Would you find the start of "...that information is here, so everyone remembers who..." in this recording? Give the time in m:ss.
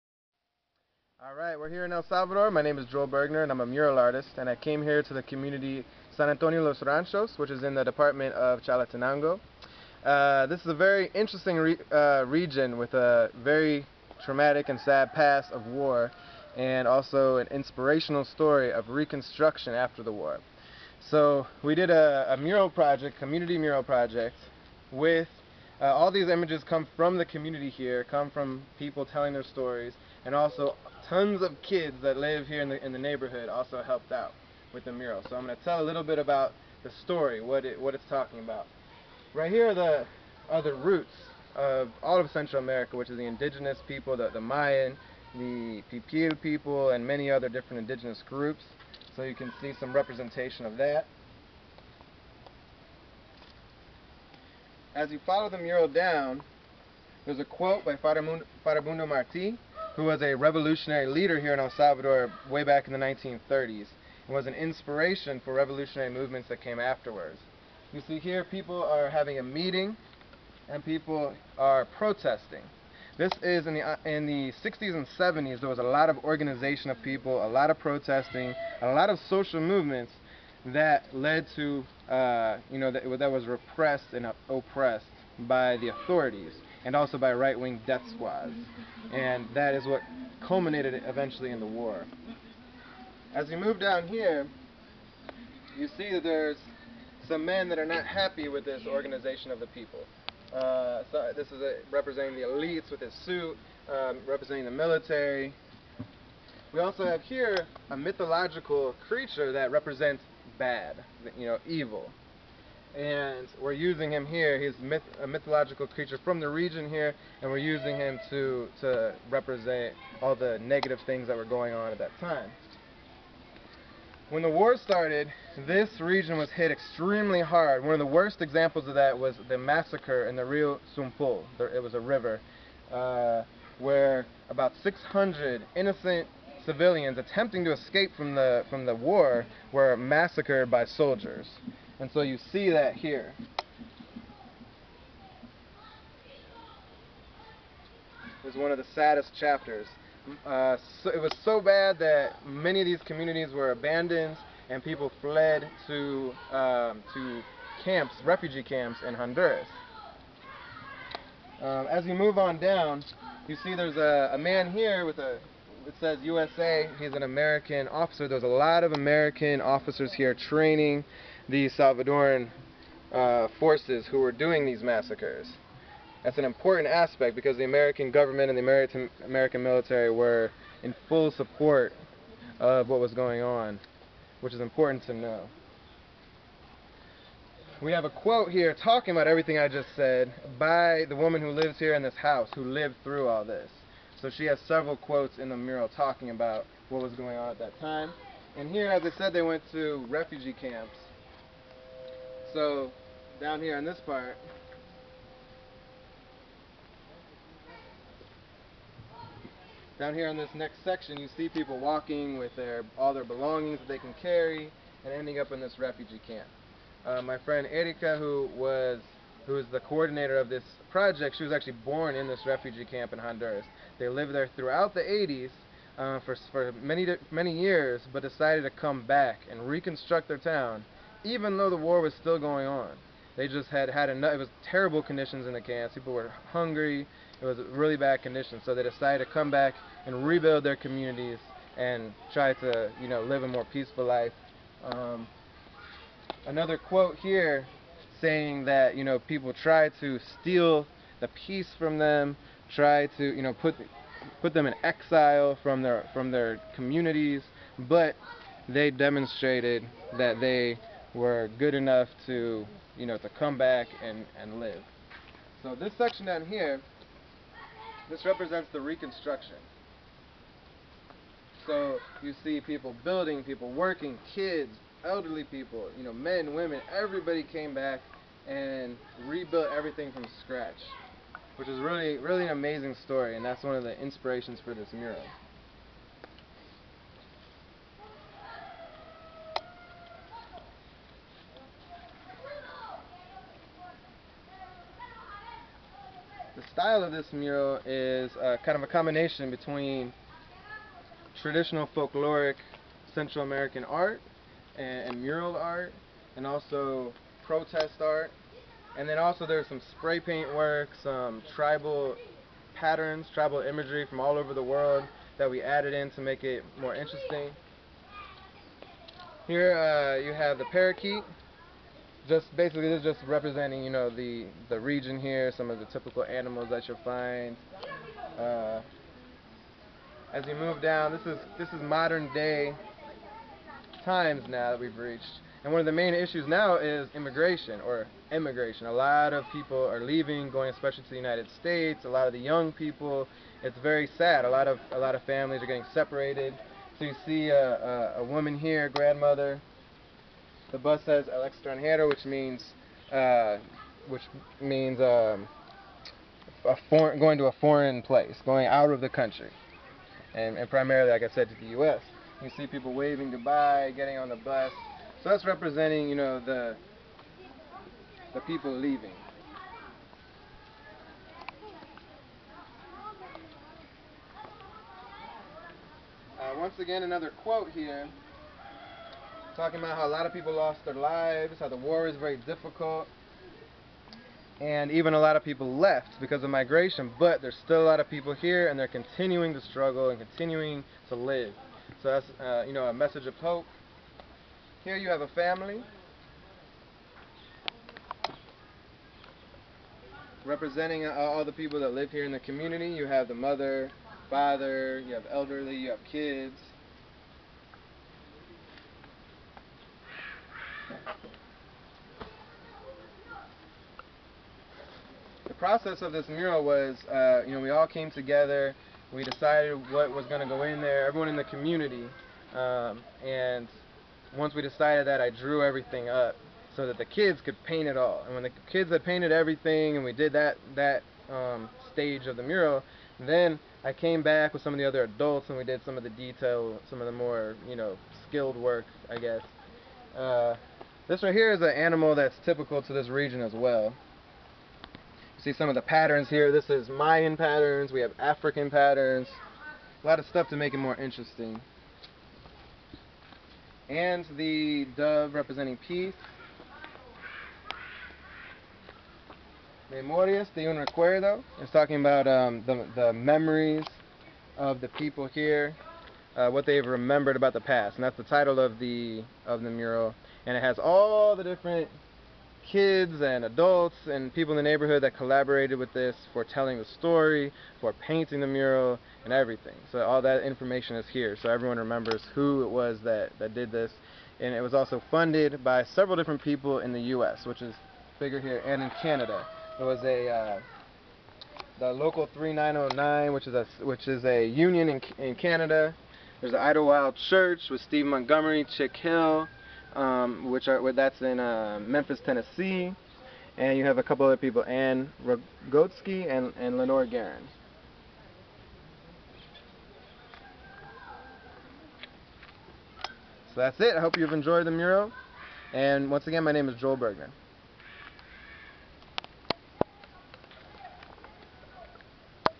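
8:00.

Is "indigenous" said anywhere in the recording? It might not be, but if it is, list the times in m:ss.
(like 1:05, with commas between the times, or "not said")
0:43, 0:47.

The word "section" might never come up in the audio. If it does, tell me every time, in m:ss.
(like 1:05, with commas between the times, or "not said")
3:30, 4:25.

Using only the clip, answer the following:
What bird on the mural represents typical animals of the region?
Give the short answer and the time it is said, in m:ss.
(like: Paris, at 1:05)
parakeet, at 5:20.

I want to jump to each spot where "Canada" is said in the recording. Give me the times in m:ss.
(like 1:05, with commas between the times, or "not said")
8:09, 8:15.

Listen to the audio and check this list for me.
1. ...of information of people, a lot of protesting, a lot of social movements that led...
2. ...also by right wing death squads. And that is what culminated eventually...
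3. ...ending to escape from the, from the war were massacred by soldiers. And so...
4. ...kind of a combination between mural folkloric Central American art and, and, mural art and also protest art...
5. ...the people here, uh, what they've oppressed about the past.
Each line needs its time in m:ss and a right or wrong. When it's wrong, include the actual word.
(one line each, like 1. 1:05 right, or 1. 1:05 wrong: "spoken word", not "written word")
1. 1:16 wrong: "organization", not "information"
2. 1:26 right
3. 2:17 wrong: "attempting", not "ending"
4. 4:58 wrong: "traditional", not "mural"
5. 7:44 wrong: "remembered", not "oppressed".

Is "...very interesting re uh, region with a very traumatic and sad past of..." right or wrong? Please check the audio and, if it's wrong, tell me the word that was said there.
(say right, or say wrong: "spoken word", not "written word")
right.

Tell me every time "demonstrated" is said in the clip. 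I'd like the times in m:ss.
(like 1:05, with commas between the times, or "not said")
4:18.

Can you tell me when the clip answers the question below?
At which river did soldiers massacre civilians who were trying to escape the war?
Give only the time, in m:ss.
2:10.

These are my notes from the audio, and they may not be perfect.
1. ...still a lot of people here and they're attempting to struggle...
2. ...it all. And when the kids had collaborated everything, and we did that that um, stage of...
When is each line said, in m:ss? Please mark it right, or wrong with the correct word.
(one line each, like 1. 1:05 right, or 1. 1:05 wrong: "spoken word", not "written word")
1. 6:27 wrong: "continuing", not "attempting"
2. 7:07 wrong: "painted", not "collaborated".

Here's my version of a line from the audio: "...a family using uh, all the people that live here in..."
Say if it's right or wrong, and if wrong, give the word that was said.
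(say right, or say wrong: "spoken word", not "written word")
wrong: "representing", not "using".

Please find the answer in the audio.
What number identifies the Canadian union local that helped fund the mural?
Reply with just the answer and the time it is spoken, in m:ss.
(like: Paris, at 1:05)
3909, at 8:12.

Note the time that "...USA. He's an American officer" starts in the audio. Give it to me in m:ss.
2:46.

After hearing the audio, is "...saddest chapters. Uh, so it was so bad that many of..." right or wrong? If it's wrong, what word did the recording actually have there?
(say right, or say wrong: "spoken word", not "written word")
right.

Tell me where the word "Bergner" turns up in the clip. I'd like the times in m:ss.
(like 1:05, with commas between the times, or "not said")
0:03, 8:36.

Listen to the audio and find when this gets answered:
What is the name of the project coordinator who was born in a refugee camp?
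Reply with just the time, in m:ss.
3:37.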